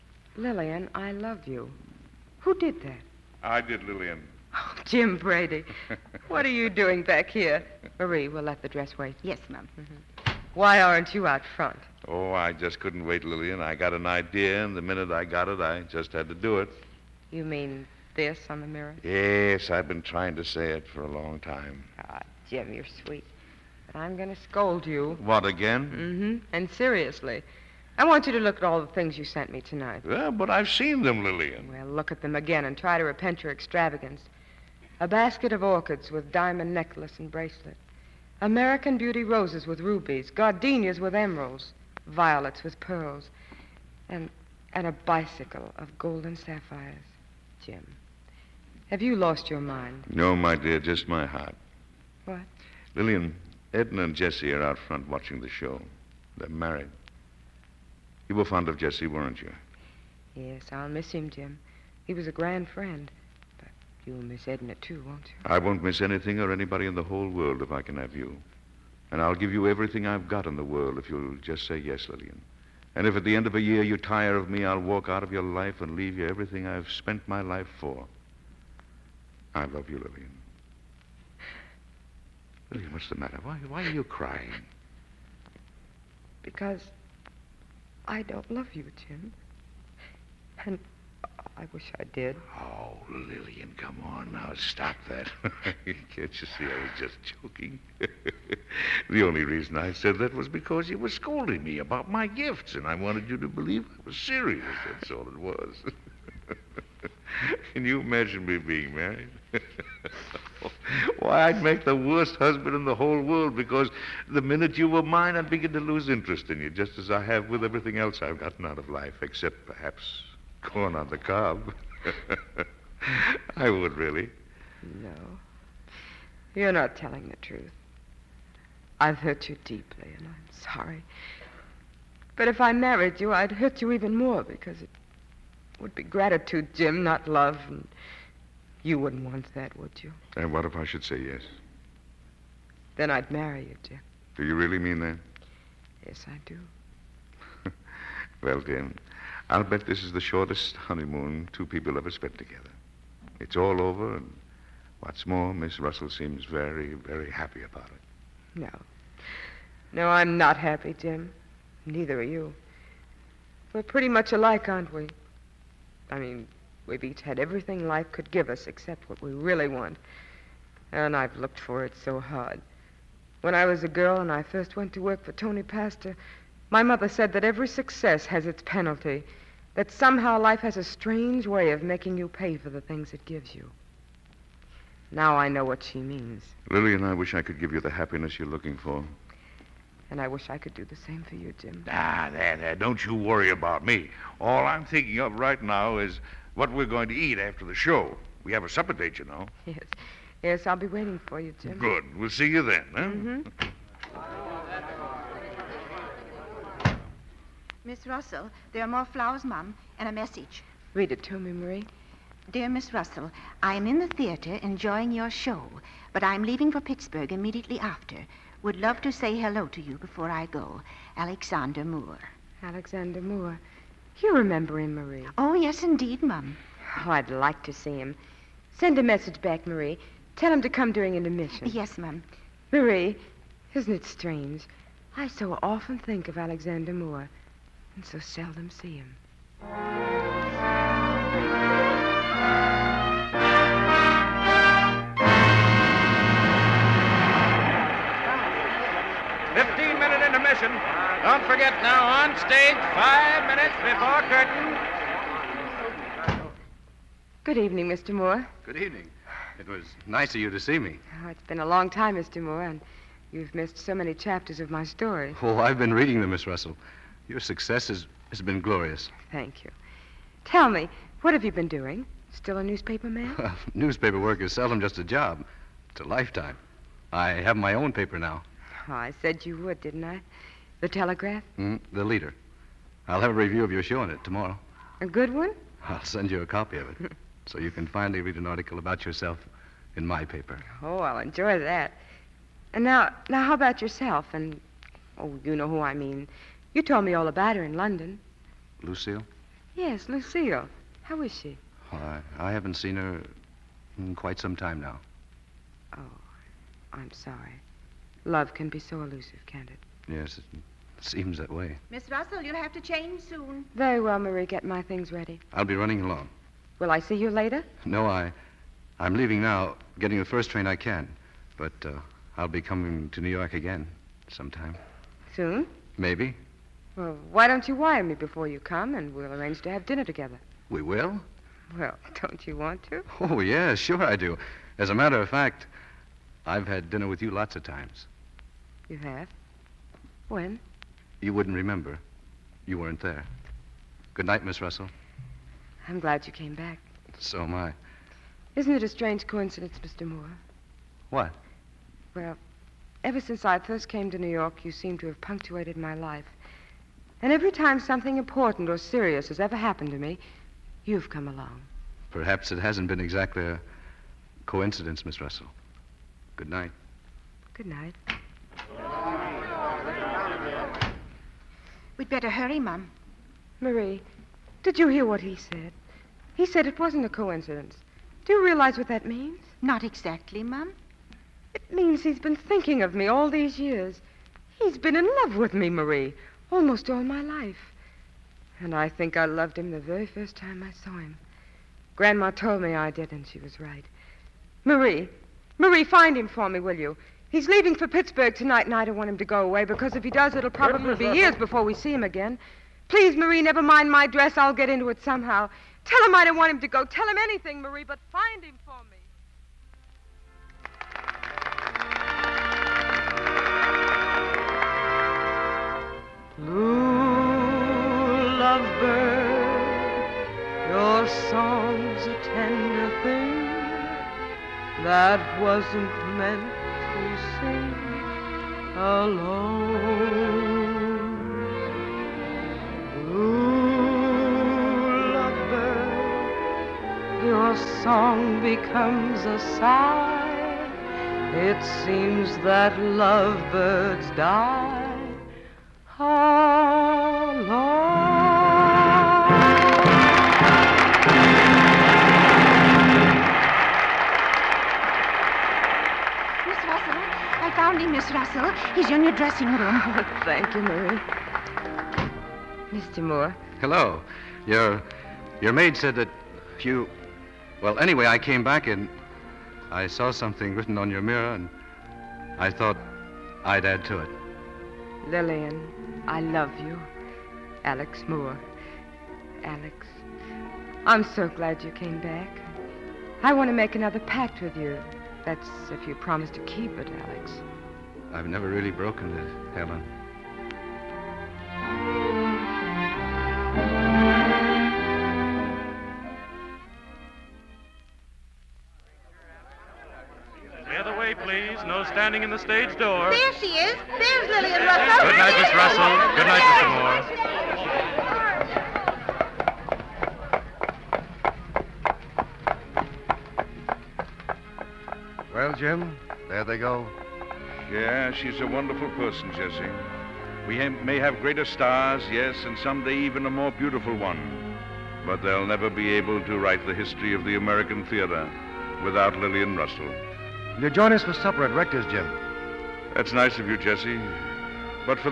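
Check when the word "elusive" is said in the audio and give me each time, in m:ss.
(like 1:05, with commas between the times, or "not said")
5:09.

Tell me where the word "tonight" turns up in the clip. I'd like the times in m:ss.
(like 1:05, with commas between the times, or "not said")
0:29, 6:38.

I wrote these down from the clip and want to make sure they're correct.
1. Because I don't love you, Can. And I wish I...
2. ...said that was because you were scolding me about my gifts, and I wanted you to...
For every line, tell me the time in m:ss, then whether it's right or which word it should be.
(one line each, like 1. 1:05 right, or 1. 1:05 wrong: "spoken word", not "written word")
1. 1:26 wrong: "Jim", not "Can"
2. 1:39 right.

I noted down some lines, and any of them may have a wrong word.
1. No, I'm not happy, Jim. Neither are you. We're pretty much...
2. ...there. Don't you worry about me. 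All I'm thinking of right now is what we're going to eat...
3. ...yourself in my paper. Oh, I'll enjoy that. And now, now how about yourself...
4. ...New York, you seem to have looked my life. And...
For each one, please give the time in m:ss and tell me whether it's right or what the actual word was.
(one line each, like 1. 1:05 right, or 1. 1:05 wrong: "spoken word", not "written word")
1. 2:39 right
2. 3:12 right
3. 4:49 right
4. 5:54 wrong: "punctuated", not "looked".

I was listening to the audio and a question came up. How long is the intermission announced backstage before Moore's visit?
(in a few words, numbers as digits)
15 minutes.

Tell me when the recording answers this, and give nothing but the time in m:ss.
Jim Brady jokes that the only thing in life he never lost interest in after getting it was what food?
2:00.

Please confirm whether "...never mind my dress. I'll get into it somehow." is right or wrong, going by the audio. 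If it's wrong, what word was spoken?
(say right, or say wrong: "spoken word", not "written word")
right.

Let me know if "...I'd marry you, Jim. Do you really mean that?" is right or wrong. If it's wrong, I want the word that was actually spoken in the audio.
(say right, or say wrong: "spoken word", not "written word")
right.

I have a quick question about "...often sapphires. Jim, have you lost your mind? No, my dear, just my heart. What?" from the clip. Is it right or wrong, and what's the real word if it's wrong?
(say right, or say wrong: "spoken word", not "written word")
wrong: "golden", not "often".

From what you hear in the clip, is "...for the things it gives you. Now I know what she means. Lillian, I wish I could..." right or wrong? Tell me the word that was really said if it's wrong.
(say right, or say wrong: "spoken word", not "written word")
right.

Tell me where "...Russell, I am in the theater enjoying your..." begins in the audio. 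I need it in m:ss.
3:32.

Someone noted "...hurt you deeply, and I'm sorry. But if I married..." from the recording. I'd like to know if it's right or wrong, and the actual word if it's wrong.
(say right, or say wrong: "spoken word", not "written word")
right.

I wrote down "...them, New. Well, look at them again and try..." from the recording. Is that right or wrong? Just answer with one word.
wrong.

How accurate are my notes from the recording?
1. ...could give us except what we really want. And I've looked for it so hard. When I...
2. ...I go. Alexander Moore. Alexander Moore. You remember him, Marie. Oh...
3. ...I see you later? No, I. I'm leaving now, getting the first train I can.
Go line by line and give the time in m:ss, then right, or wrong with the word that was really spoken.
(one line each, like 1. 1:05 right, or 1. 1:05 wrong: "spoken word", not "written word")
1. 2:48 right
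2. 3:40 right
3. 5:16 right.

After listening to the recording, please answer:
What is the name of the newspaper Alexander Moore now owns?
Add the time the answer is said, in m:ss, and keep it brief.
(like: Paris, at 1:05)
The Telegraph, at 4:40.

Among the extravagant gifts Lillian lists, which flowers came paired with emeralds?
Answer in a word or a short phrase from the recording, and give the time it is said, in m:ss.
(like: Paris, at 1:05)
Gardenias, at 0:40.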